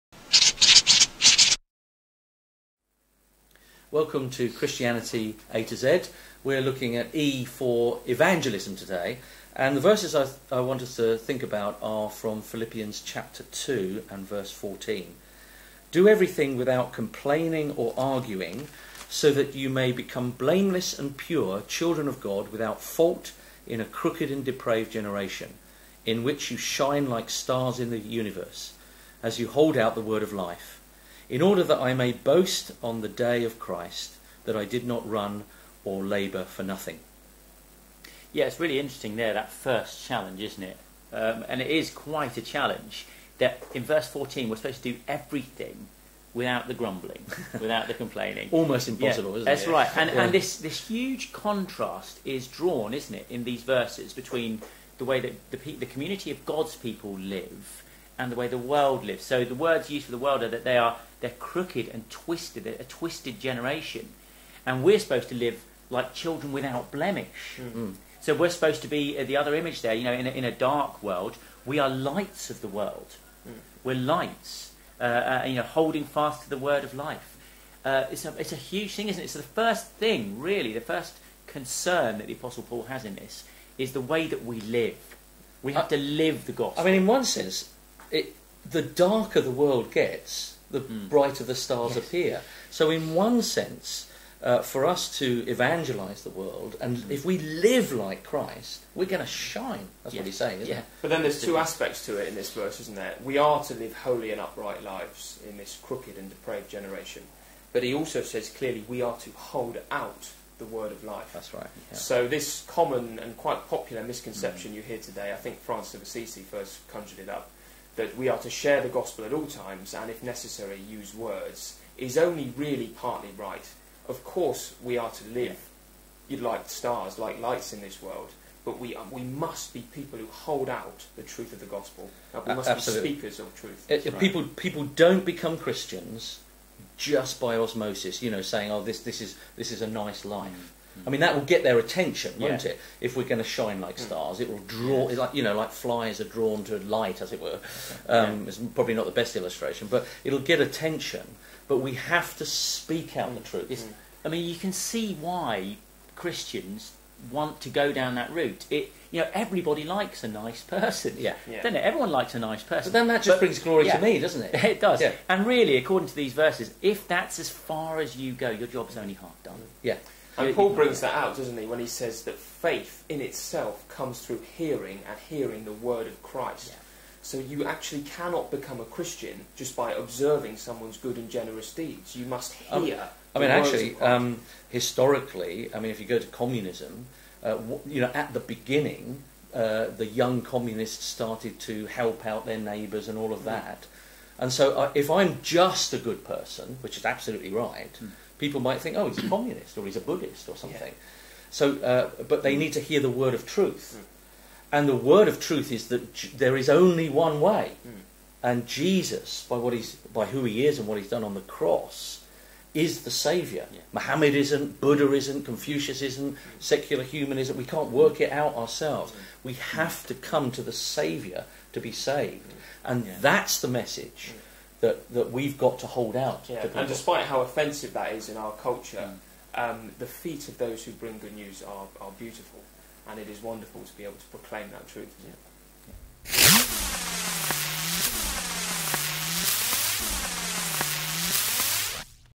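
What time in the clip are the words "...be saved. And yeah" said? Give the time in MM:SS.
03:41.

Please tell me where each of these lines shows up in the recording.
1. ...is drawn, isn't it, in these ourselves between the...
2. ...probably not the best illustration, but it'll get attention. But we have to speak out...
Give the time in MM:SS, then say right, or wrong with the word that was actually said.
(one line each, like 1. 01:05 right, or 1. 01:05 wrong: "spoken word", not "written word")
1. 00:52 wrong: "verses", not "ourselves"
2. 02:28 right.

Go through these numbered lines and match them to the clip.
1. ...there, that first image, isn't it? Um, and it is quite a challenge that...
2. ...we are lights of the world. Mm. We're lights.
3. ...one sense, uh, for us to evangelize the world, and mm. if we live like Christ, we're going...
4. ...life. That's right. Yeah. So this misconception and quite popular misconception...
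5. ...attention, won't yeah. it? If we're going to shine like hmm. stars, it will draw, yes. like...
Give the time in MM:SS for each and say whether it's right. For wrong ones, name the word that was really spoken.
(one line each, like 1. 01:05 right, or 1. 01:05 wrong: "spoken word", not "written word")
1. 00:39 wrong: "challenge", not "image"
2. 01:11 right
3. 01:33 right
4. 01:51 wrong: "common", not "misconception"
5. 02:21 right.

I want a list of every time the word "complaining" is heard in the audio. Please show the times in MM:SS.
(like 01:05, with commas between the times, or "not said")
00:16, 00:47.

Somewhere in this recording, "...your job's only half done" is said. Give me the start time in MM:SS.
02:48.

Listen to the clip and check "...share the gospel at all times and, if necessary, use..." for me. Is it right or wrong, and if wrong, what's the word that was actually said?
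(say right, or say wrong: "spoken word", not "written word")
right.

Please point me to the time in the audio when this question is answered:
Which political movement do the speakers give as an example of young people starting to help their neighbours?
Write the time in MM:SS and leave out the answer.
03:06.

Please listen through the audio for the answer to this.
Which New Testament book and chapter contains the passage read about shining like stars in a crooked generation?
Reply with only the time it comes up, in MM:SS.
00:12.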